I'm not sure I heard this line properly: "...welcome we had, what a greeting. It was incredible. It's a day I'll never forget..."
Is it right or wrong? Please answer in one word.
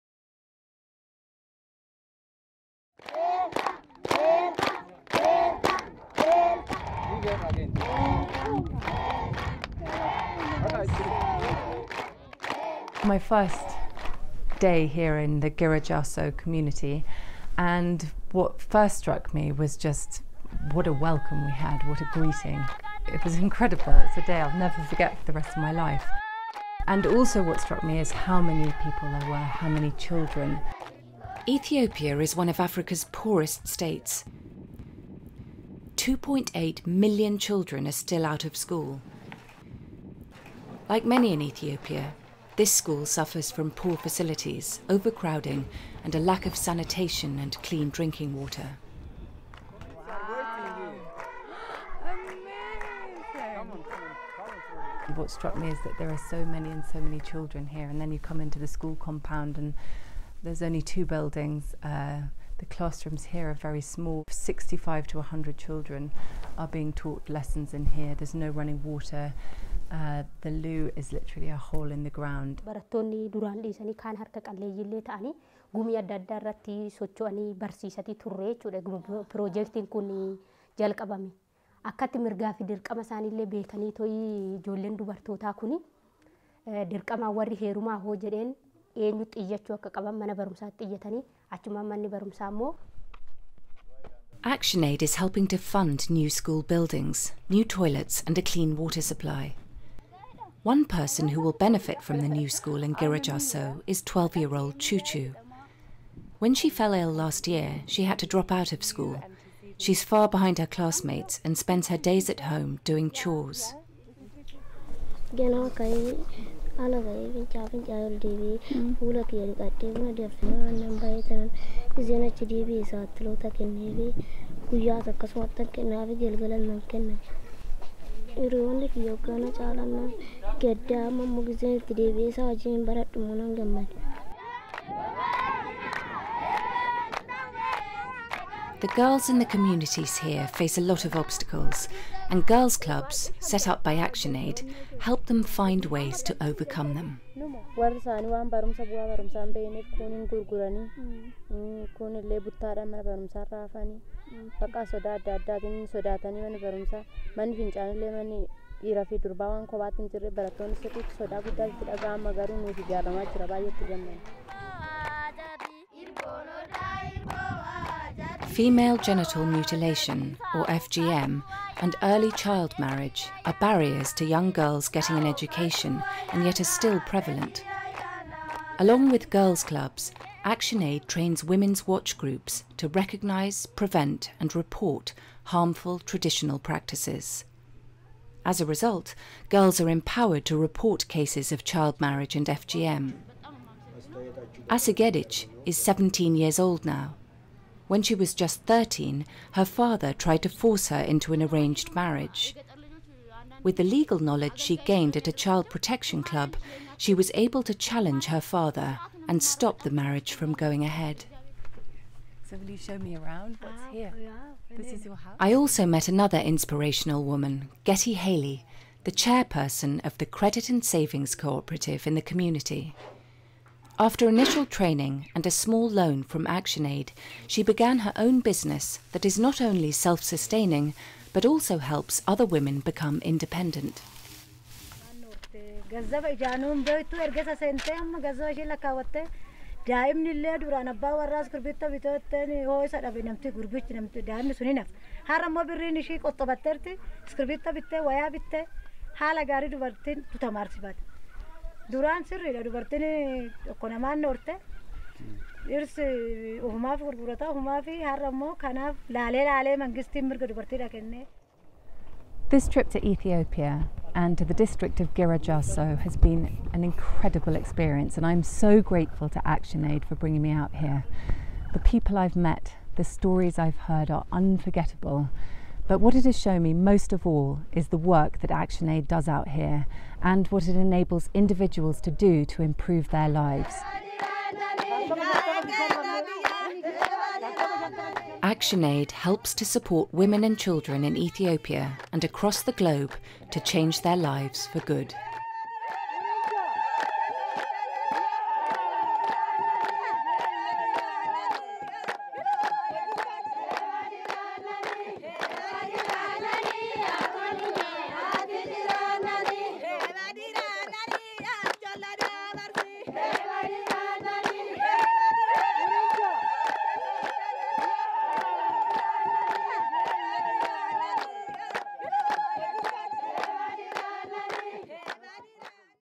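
right.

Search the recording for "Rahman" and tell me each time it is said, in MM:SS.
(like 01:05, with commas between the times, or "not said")
not said.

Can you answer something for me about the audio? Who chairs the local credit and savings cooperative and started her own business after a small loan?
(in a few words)
Getty Haley.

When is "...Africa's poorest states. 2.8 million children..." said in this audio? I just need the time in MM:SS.
00:32.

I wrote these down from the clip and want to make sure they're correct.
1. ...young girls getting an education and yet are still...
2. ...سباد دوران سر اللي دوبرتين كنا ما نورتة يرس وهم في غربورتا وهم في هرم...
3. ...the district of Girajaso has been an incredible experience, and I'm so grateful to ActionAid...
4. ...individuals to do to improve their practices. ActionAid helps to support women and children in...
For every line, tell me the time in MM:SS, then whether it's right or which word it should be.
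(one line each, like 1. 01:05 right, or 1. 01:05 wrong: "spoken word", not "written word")
1. 02:54 right
2. 04:10 right
3. 04:24 right
4. 04:41 wrong: "lives", not "practices".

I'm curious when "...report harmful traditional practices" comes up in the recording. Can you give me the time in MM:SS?
03:04.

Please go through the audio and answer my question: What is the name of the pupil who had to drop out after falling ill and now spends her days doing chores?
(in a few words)
Choo.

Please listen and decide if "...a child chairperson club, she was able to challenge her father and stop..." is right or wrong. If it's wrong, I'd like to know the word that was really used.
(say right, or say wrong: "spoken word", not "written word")
wrong: "protection", not "chairperson".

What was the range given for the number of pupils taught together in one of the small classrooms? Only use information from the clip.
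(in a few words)
65 to 100.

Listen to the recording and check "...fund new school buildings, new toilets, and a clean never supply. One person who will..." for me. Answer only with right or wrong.
wrong.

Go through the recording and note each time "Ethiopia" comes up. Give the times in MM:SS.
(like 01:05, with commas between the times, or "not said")
00:31, 00:41, 04:23, 04:51.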